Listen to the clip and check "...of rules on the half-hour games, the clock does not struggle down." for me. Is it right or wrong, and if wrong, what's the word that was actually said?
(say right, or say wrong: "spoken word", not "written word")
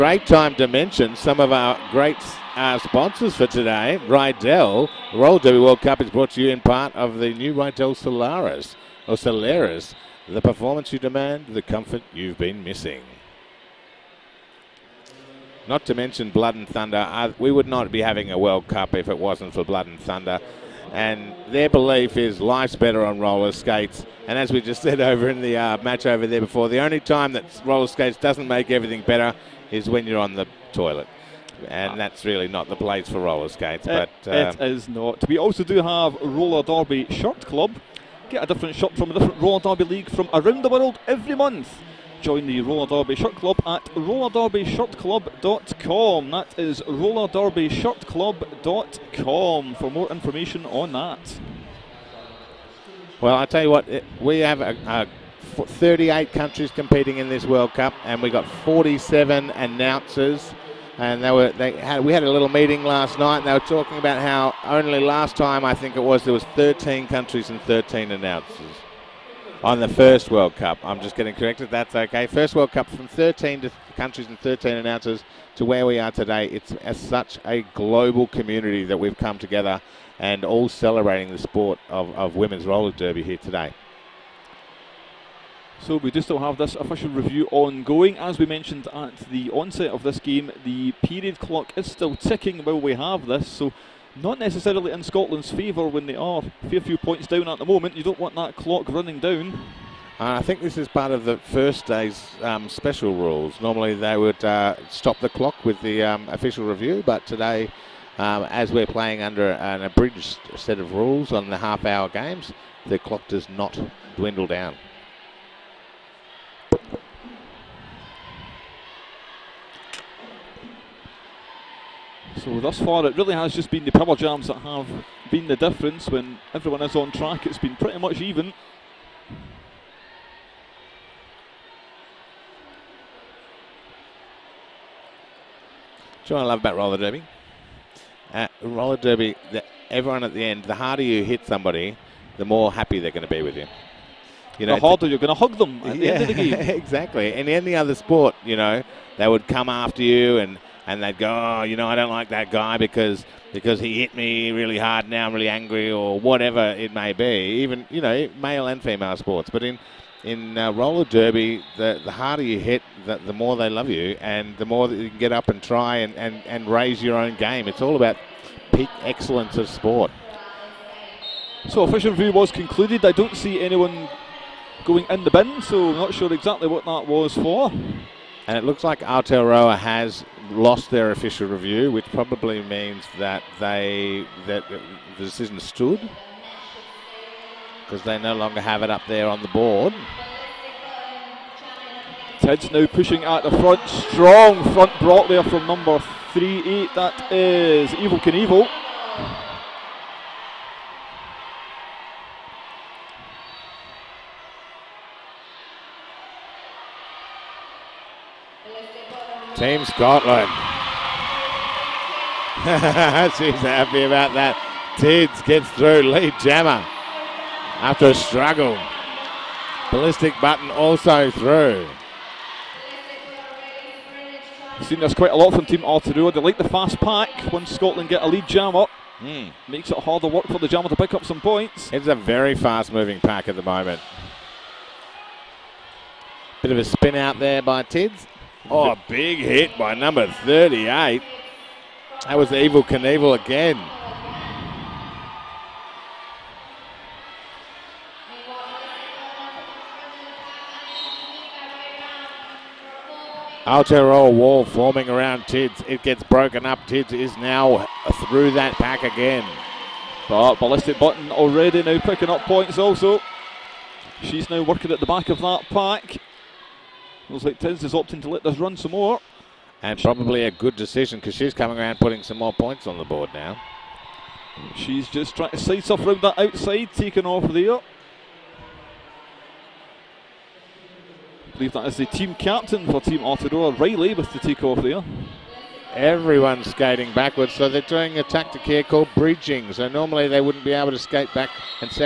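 wrong: "dwindle", not "struggle".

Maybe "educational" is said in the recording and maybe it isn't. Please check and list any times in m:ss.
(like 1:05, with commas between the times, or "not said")
not said.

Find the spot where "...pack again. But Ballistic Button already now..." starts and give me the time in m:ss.
4:18.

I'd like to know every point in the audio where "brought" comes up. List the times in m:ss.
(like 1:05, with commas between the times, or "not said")
0:06, 3:14.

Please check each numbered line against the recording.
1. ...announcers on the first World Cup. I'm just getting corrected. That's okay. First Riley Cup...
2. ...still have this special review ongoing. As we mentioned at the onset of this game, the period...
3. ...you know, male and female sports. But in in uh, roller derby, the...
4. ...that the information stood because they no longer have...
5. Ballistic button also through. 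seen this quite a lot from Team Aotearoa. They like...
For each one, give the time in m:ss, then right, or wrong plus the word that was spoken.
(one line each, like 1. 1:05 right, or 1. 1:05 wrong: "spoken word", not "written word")
1. 1:08 wrong: "World", not "Riley"
2. 1:26 wrong: "official", not "special"
3. 2:37 right
4. 3:04 wrong: "decision", not "information"
5. 3:39 right.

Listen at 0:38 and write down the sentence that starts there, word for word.
Get a different shirt from a different Roller Derby League from around the world every month.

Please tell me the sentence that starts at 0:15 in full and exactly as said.
Not to mention Blood and Thunder.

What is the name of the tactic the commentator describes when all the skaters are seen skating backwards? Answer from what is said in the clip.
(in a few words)
Bridging.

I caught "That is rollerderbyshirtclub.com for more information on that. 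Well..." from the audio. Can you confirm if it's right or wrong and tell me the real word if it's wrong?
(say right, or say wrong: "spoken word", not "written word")
right.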